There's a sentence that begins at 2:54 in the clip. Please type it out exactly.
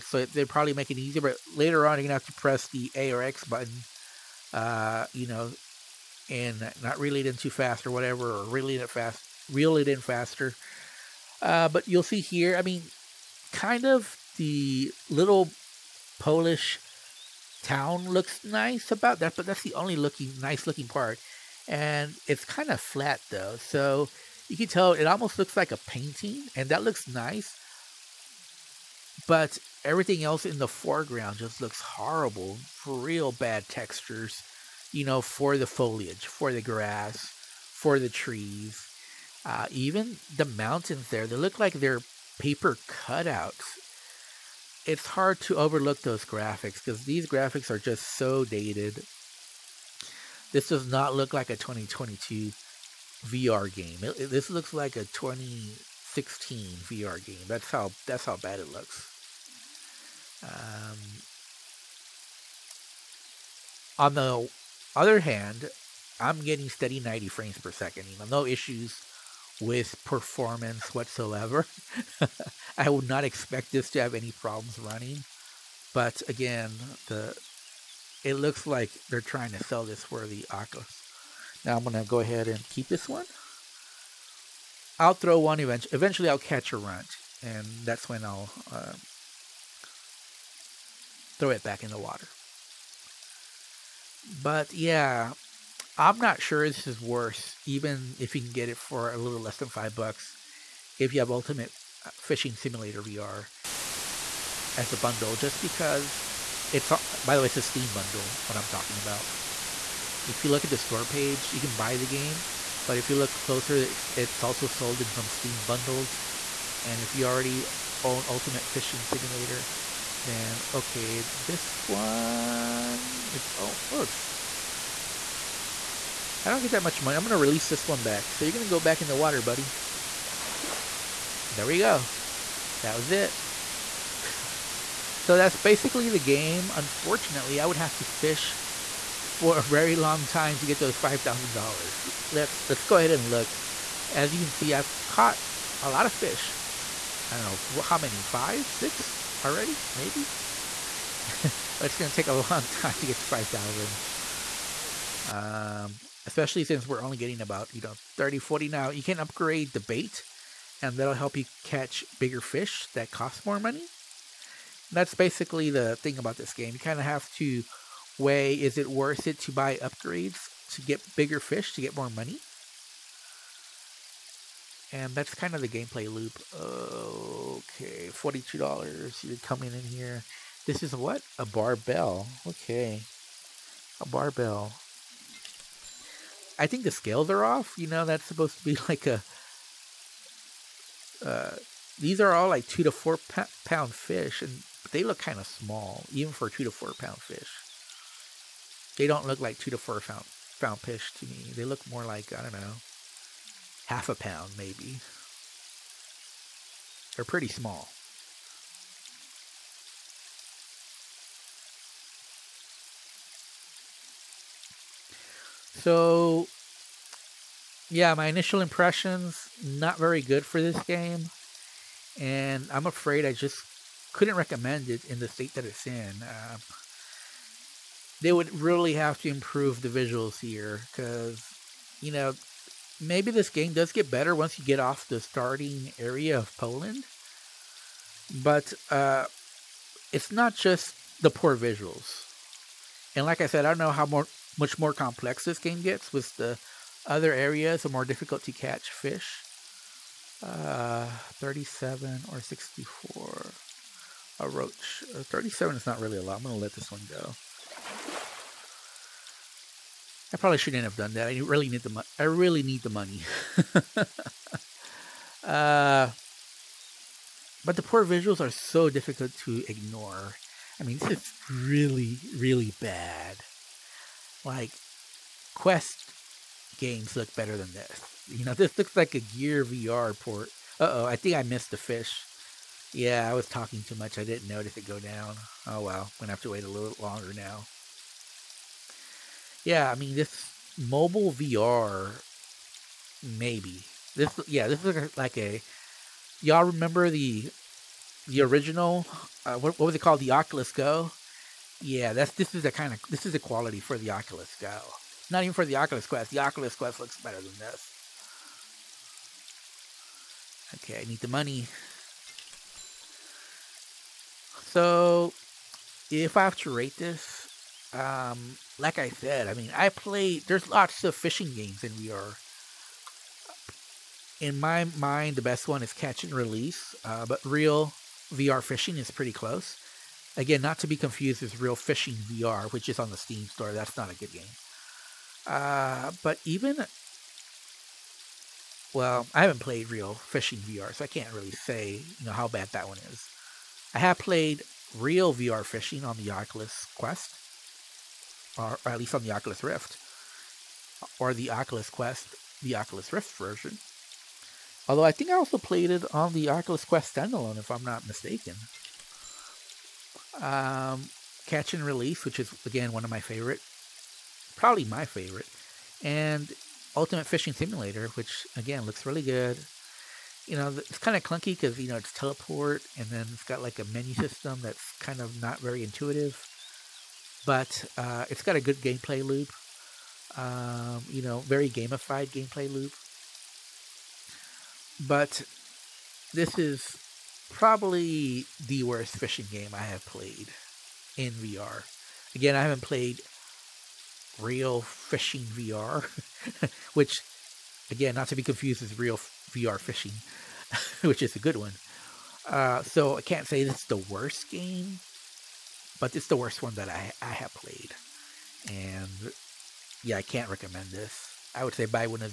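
And that's kind of the gameplay loop.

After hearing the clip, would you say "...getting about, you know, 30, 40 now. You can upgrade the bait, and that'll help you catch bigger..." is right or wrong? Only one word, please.
right.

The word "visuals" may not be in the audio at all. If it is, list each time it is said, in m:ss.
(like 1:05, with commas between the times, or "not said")
3:49, 4:01, 4:28.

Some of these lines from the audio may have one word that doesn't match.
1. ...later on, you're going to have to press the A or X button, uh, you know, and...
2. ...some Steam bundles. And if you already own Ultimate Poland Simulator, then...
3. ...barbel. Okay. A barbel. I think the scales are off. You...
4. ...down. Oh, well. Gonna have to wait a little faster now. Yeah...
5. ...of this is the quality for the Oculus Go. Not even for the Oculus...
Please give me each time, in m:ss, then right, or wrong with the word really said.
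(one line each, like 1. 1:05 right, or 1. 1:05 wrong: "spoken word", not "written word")
1. 0:01 right
2. 1:55 wrong: "Fishing", not "Poland"
3. 3:01 right
4. 4:44 wrong: "longer", not "faster"
5. 5:02 right.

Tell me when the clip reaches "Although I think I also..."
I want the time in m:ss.
5:54.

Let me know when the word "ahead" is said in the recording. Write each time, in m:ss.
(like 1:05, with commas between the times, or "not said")
1:22, 2:22.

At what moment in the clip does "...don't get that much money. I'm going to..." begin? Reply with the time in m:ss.
2:06.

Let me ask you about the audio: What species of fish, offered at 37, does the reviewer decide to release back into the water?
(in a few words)
Roach.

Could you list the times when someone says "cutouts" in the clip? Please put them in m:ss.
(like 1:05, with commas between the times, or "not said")
0:42.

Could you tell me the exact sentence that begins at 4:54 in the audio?
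This, yeah, this looks like a...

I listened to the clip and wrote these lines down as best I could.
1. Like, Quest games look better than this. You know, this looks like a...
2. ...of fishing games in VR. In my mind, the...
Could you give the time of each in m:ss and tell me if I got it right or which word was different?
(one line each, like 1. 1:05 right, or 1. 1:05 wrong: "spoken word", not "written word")
1. 4:34 right
2. 5:21 right.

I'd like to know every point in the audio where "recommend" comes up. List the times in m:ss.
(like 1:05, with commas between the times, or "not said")
3:44, 6:50.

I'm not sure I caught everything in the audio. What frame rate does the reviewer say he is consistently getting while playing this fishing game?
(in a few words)
90 frames per second.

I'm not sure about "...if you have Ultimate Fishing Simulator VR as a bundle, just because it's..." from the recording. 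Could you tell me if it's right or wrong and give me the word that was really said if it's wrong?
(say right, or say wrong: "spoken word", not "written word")
right.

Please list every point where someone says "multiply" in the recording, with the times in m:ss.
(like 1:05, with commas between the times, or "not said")
not said.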